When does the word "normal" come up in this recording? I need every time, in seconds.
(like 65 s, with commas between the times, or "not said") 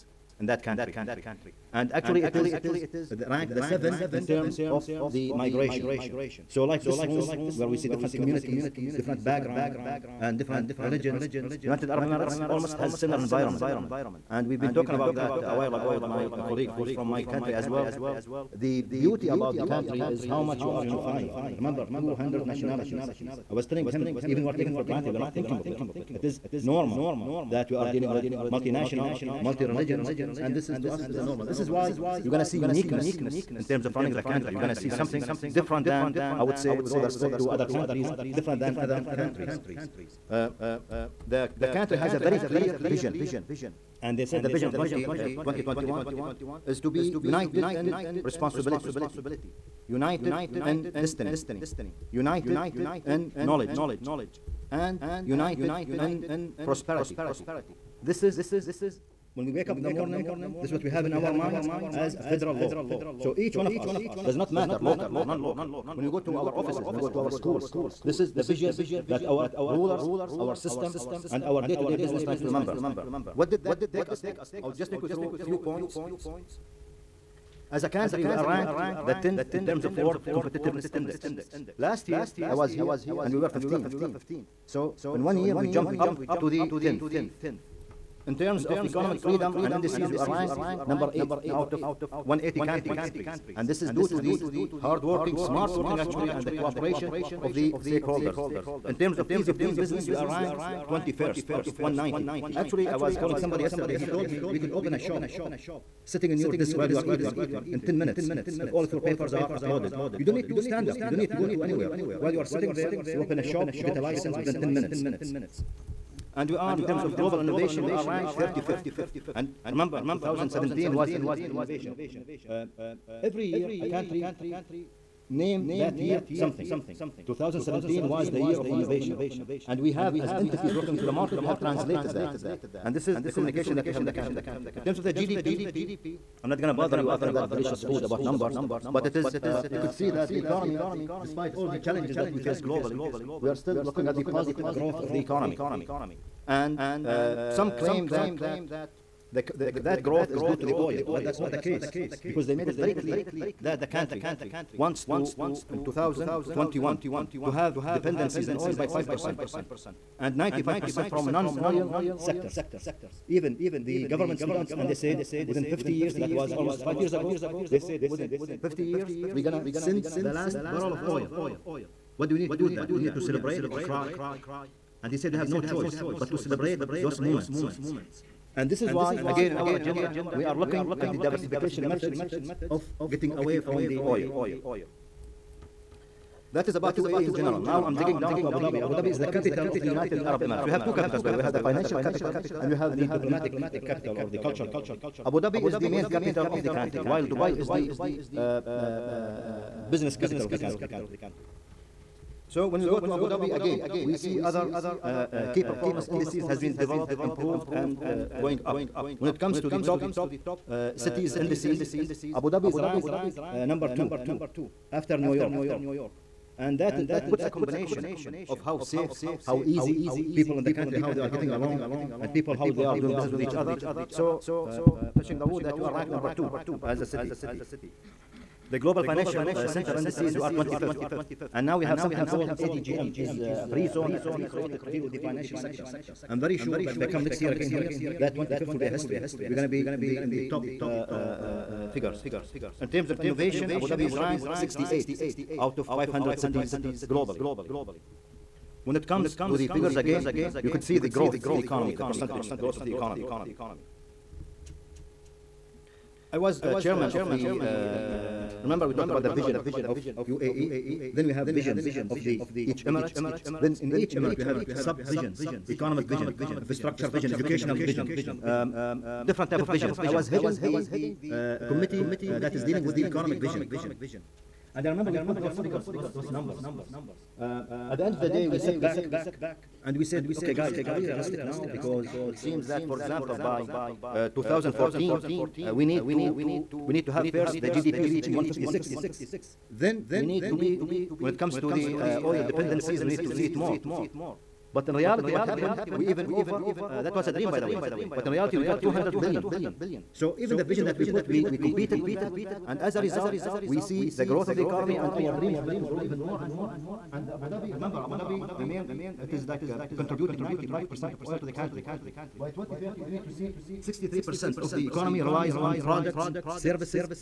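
26 s, 31 s.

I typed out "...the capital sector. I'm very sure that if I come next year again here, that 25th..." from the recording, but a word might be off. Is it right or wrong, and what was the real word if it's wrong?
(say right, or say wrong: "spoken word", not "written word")
wrong: "financial", not "capital".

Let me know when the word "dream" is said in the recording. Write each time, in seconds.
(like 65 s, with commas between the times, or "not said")
297 s, 305 s.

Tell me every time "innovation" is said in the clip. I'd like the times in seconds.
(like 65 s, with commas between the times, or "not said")
117 s, 121 s, 128 s, 243 s.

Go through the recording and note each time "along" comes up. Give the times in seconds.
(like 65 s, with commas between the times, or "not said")
221 s.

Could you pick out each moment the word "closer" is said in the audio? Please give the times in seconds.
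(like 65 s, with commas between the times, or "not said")
not said.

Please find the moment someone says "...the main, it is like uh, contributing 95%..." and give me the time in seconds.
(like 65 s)
308 s.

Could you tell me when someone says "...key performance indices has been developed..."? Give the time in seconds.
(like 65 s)
205 s.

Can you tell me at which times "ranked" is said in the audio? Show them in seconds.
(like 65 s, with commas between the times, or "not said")
3 s, 78 s, 90 s, 100 s, 118 s, 212 s, 225 s, 244 s.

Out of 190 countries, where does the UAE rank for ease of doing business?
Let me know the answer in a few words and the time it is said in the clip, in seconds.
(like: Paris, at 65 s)
21st, at 100 s.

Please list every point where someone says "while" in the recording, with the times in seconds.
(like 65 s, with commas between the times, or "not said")
15 s, 106 s, 112 s, 197 s.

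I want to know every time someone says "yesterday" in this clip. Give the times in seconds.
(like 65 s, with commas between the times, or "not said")
103 s.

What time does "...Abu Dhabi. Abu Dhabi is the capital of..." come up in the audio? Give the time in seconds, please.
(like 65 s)
188 s.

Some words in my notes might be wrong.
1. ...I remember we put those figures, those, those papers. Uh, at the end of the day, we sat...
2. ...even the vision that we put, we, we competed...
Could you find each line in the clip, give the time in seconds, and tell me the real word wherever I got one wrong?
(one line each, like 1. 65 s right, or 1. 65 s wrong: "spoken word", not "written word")
1. 274 s wrong: "numbers", not "papers"
2. 300 s right.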